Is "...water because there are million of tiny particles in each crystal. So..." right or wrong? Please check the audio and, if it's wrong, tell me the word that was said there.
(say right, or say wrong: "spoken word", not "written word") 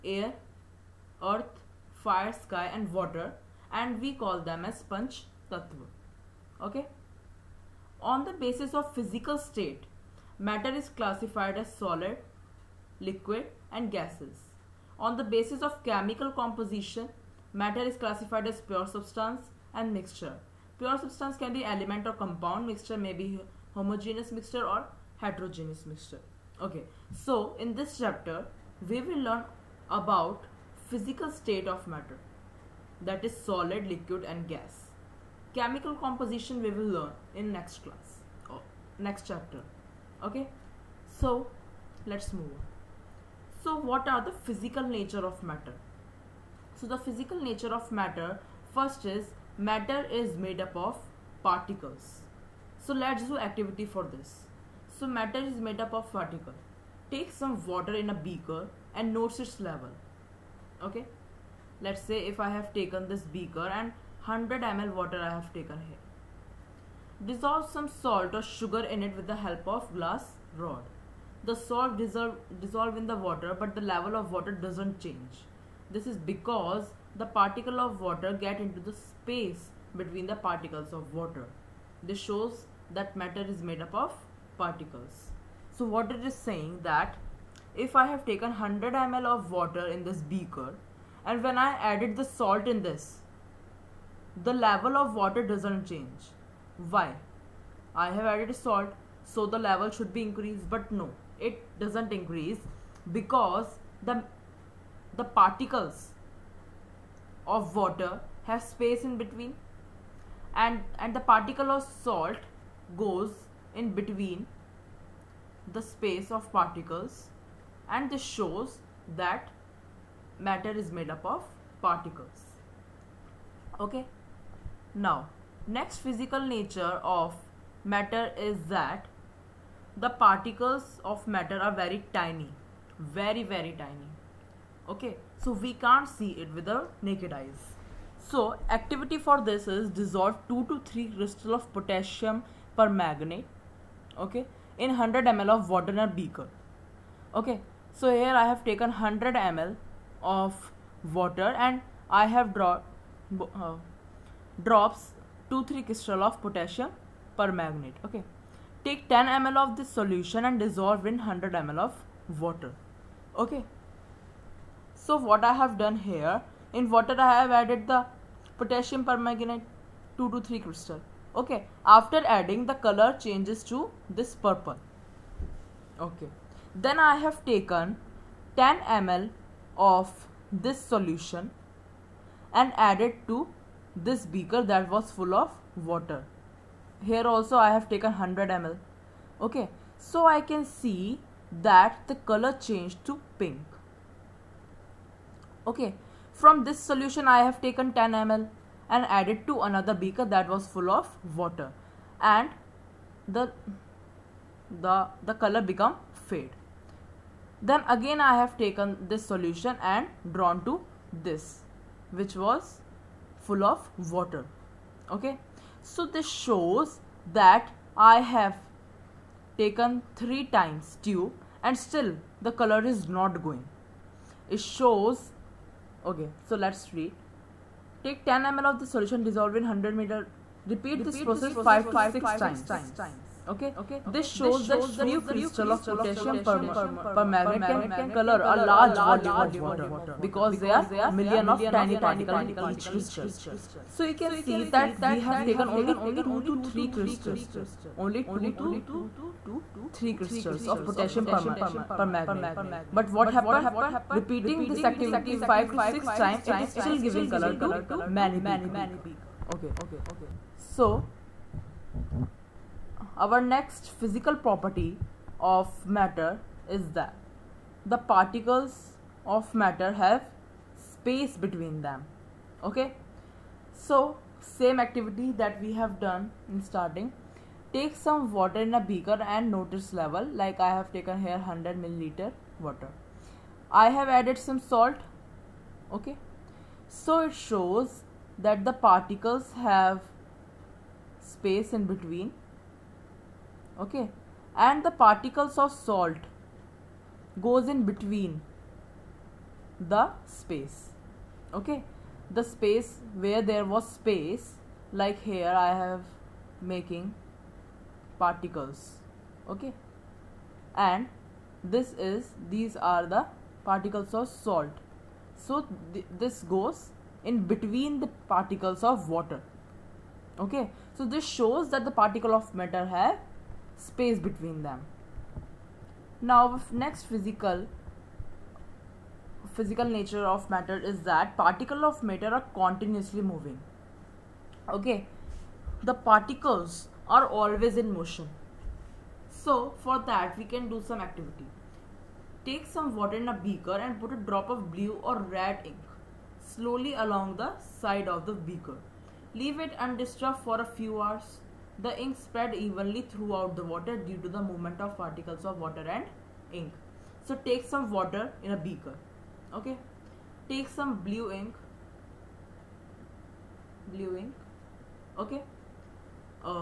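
right.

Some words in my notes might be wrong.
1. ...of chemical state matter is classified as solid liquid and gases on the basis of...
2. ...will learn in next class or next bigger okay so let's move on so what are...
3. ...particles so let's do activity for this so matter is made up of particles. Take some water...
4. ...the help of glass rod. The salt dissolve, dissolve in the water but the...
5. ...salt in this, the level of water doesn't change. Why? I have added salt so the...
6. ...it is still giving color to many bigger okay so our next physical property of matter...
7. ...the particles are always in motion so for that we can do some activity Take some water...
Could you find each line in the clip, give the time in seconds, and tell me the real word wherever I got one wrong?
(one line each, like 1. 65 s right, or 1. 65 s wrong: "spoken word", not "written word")
1. 8 s wrong: "physical", not "chemical"
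2. 36 s wrong: "chapter", not "bigger"
3. 51 s right
4. 69 s right
5. 92 s right
6. 256 s right
7. 335 s right.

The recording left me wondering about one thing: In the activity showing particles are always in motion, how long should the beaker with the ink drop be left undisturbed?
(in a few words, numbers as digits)
A few hours.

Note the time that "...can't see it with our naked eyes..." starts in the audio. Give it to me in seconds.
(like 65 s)
135 s.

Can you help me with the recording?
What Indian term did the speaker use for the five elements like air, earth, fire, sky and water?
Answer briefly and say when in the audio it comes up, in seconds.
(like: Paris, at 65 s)
Panch tattva, at 4 s.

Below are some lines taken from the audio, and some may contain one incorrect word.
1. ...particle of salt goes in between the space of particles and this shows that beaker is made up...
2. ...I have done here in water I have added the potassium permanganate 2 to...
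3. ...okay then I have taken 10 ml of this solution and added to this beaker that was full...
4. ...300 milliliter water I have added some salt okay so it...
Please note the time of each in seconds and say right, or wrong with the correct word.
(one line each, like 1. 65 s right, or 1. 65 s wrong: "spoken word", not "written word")
1. 111 s wrong: "matter", not "beaker"
2. 165 s right
3. 175 s right
4. 281 s wrong: "100", not "300".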